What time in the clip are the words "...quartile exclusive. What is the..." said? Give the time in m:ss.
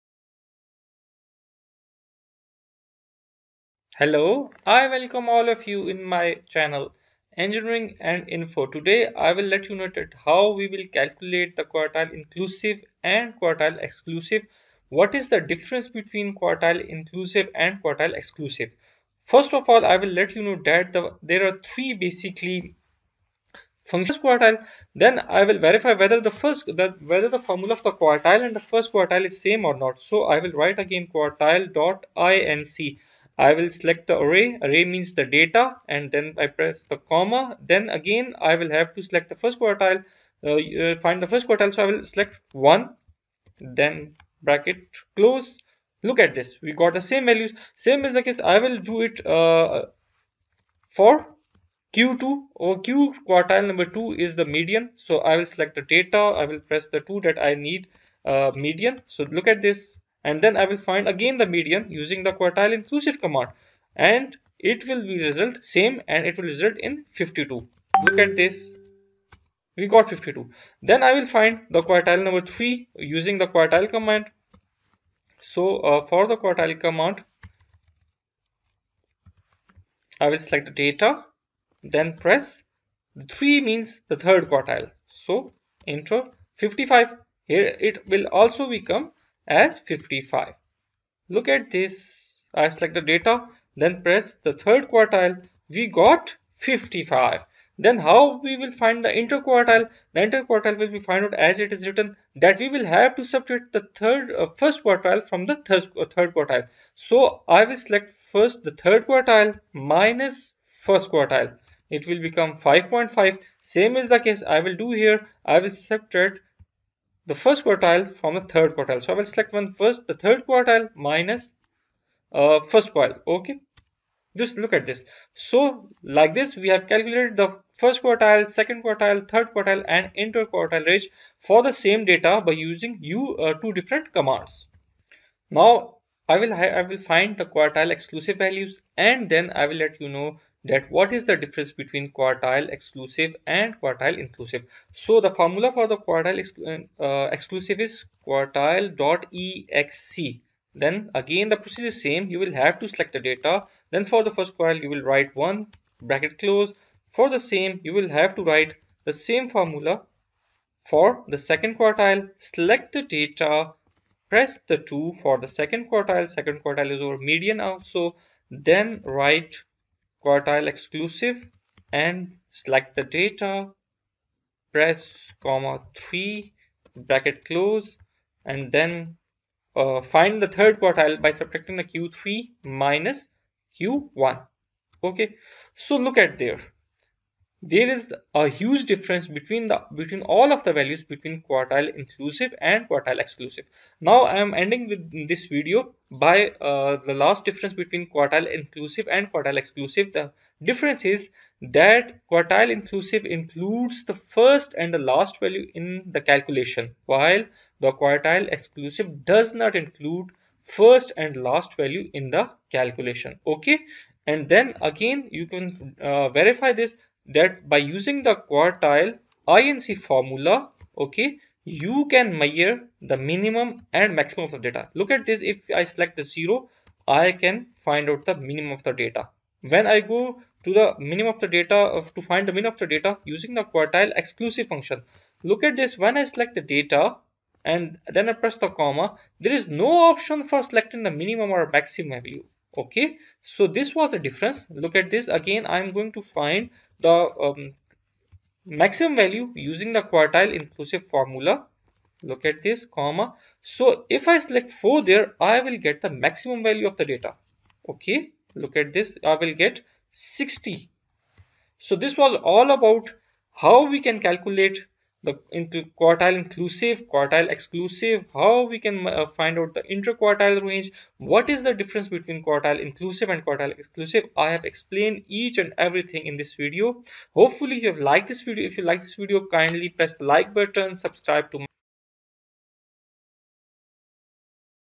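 0:13.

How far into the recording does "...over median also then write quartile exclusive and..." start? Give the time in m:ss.
2:47.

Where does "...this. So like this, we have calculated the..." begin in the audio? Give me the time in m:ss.
2:04.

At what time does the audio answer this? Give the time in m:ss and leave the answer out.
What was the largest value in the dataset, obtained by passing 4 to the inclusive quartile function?
4:20.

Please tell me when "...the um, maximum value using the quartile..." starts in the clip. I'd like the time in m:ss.
4:07.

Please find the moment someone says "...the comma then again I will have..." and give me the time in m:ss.
0:36.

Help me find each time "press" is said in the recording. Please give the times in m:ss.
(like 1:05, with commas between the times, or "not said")
0:36, 0:56, 1:22, 1:34, 2:44, 2:54, 3:58, 4:39.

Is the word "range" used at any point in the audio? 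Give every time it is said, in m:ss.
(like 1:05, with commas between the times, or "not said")
2:10, 4:30.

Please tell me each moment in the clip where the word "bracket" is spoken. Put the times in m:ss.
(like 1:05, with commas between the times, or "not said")
0:44, 2:36, 2:57.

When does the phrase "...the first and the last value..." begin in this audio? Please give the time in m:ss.
3:24.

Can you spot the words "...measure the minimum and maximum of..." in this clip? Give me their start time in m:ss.
3:42.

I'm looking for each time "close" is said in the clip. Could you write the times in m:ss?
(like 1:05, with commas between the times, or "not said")
0:45, 2:36, 2:57.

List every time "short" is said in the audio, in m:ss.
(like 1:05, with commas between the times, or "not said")
not said.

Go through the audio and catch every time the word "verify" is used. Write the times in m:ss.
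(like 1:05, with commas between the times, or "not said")
0:25, 3:36.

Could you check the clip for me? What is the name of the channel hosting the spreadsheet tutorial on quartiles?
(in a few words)
Engineering and Info.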